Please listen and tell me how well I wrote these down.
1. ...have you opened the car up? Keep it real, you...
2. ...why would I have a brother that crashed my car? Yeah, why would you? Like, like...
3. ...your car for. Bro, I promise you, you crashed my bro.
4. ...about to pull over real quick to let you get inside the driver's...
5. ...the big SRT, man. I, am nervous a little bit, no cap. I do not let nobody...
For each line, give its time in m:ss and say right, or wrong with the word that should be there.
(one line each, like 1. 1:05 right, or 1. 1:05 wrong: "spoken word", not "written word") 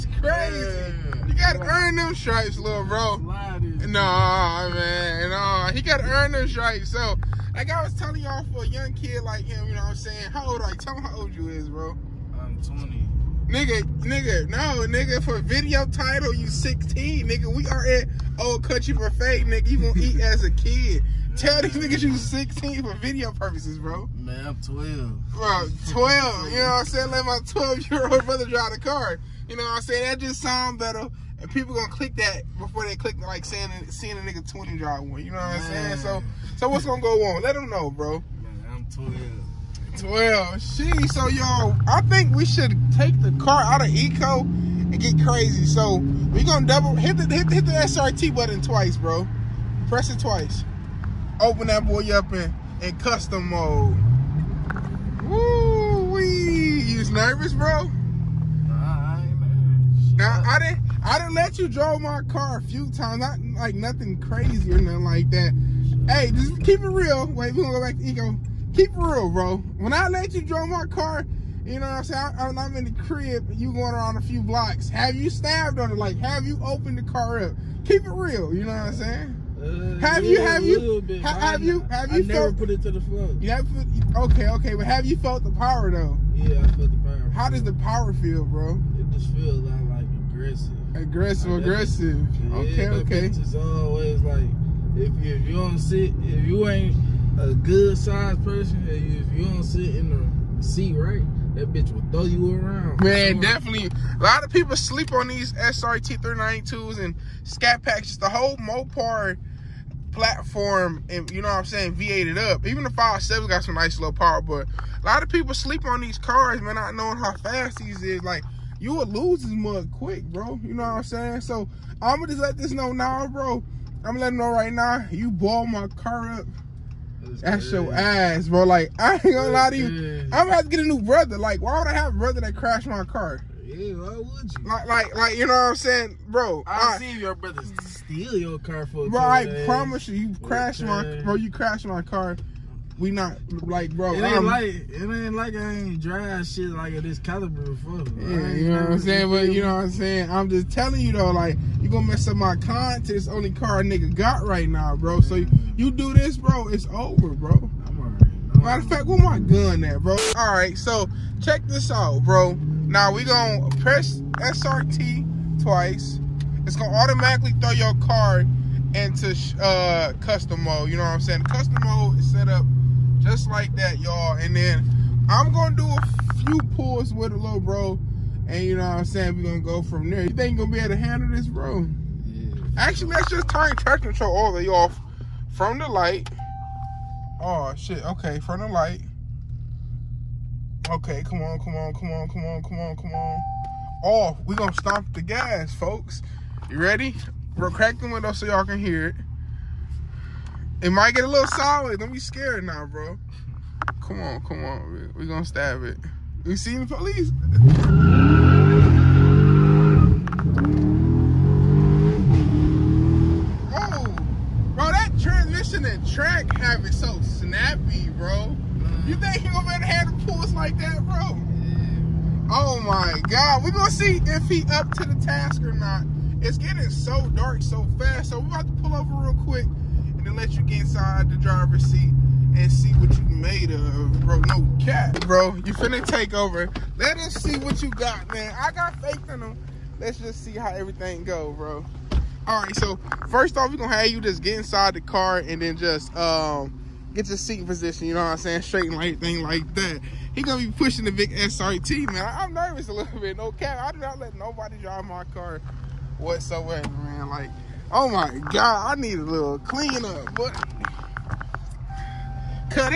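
1. 1:16 right
2. 2:11 right
3. 2:18 right
4. 3:48 right
5. 4:11 right.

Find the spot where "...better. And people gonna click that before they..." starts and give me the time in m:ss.
0:30.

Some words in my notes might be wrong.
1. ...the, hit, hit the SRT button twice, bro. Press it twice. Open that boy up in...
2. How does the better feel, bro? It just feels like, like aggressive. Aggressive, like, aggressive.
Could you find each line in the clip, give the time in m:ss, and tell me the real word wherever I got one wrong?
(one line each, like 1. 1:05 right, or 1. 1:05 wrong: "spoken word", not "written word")
1. 0:47 right
2. 1:27 wrong: "power", not "better".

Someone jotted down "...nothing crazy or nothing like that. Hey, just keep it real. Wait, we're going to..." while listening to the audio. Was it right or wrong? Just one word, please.
right.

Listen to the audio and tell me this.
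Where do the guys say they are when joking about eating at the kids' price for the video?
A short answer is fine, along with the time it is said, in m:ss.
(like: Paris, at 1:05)
Old Country Buffet, at 0:18.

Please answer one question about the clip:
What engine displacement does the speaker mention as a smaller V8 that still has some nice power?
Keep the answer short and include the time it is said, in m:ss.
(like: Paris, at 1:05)
5.7, at 1:52.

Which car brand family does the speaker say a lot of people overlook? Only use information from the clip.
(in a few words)
Mopar.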